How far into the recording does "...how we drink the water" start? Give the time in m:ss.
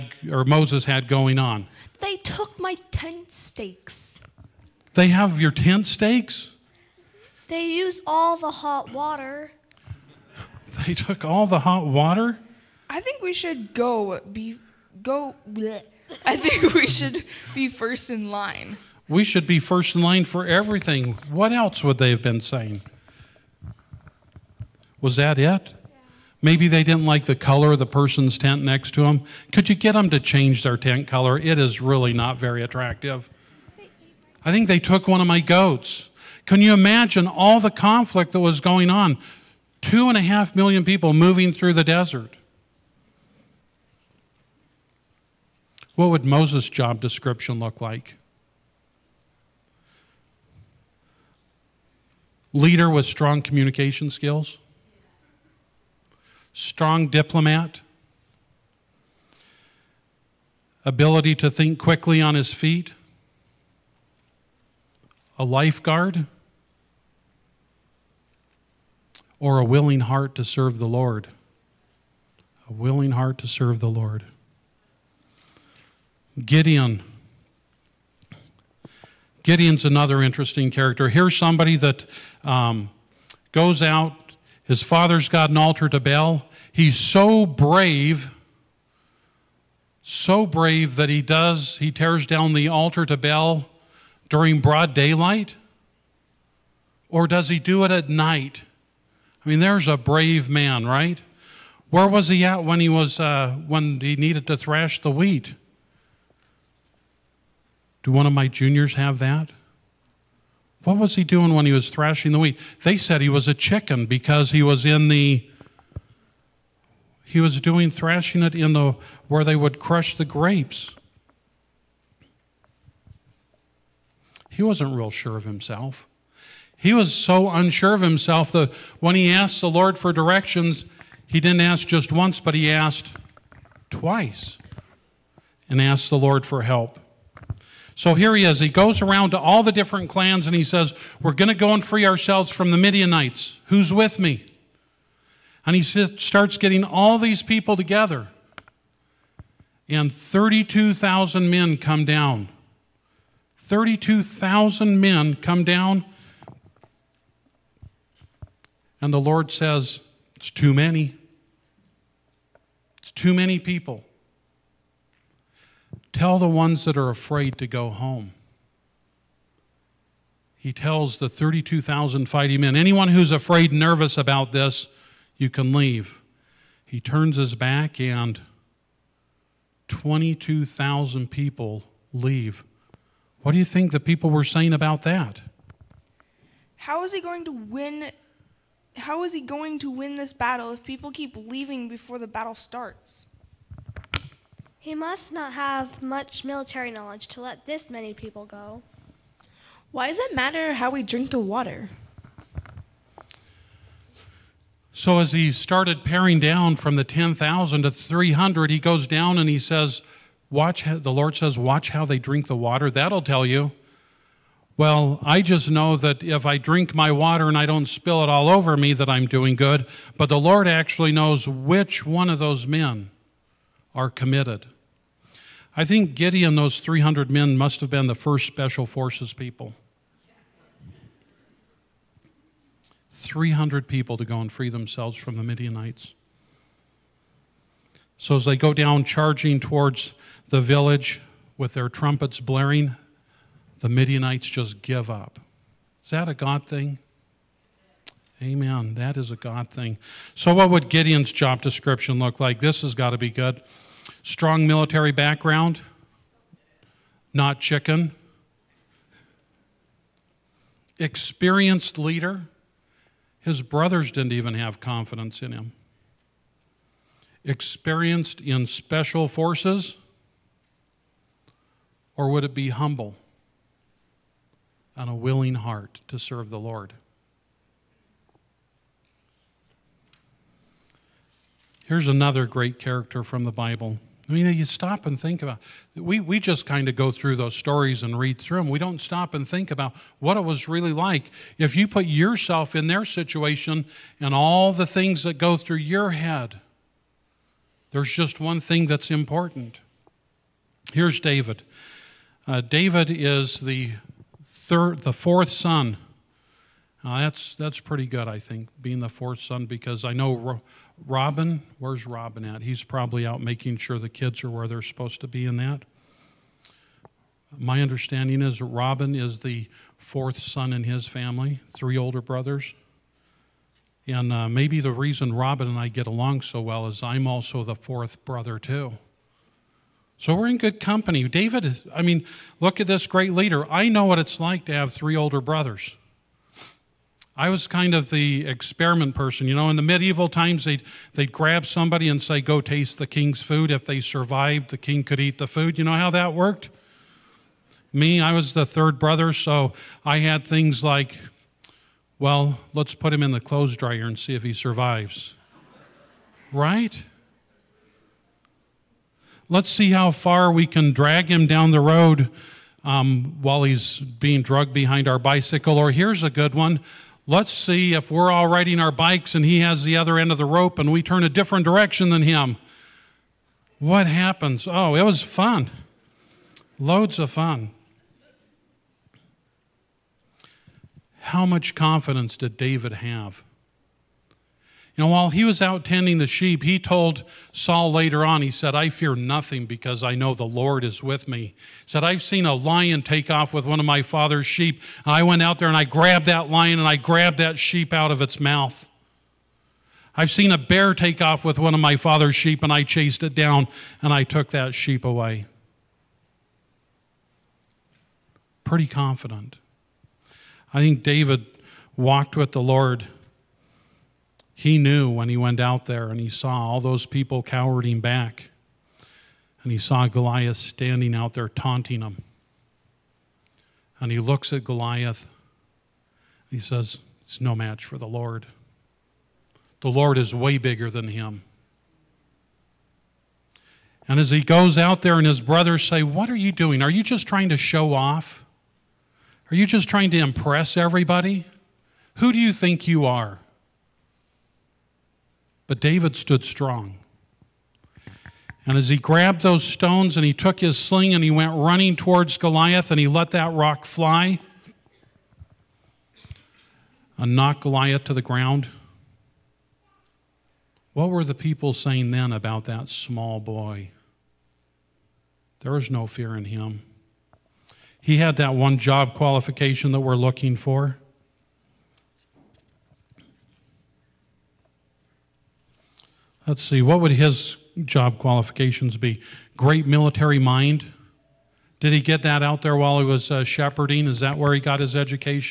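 3:20.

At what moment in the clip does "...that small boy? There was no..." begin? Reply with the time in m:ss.
7:42.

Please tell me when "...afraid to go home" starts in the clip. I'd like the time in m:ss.
2:47.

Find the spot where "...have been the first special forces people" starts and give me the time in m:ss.
3:47.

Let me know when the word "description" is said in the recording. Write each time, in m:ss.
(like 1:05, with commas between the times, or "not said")
0:46, 4:11.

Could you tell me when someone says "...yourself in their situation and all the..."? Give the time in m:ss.
4:52.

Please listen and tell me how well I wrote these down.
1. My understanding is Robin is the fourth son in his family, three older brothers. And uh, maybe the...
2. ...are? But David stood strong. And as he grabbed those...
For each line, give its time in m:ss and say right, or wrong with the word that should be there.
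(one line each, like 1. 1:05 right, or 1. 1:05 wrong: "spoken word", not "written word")
1. 5:17 right
2. 7:23 right.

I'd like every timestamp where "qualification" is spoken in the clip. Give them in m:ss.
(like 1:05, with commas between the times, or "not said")
7:49, 7:58.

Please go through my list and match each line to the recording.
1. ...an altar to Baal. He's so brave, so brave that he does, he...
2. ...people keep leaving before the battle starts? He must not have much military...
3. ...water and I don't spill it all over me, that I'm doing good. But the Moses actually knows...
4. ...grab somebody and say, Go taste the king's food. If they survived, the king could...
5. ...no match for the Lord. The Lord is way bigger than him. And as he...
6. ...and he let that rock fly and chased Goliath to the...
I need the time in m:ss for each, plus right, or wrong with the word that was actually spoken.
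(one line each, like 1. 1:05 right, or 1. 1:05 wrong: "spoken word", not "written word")
1. 1:25 right
2. 3:10 right
3. 3:37 wrong: "Lord", not "Moses"
4. 5:41 right
5. 7:07 right
6. 7:32 wrong: "knocked", not "chased".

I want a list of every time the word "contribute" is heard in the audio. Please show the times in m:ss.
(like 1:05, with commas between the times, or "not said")
not said.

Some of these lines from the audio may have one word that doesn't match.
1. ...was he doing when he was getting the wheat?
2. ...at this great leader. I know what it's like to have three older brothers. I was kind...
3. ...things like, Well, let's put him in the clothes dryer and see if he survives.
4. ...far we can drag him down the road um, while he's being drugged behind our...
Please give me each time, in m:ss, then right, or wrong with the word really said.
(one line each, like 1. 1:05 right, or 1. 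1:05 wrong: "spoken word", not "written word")
1. 1:50 wrong: "thrashing", not "getting"
2. 5:32 right
3. 5:50 right
4. 6:00 right.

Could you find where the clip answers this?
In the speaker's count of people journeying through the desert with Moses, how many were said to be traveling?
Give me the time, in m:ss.
0:39.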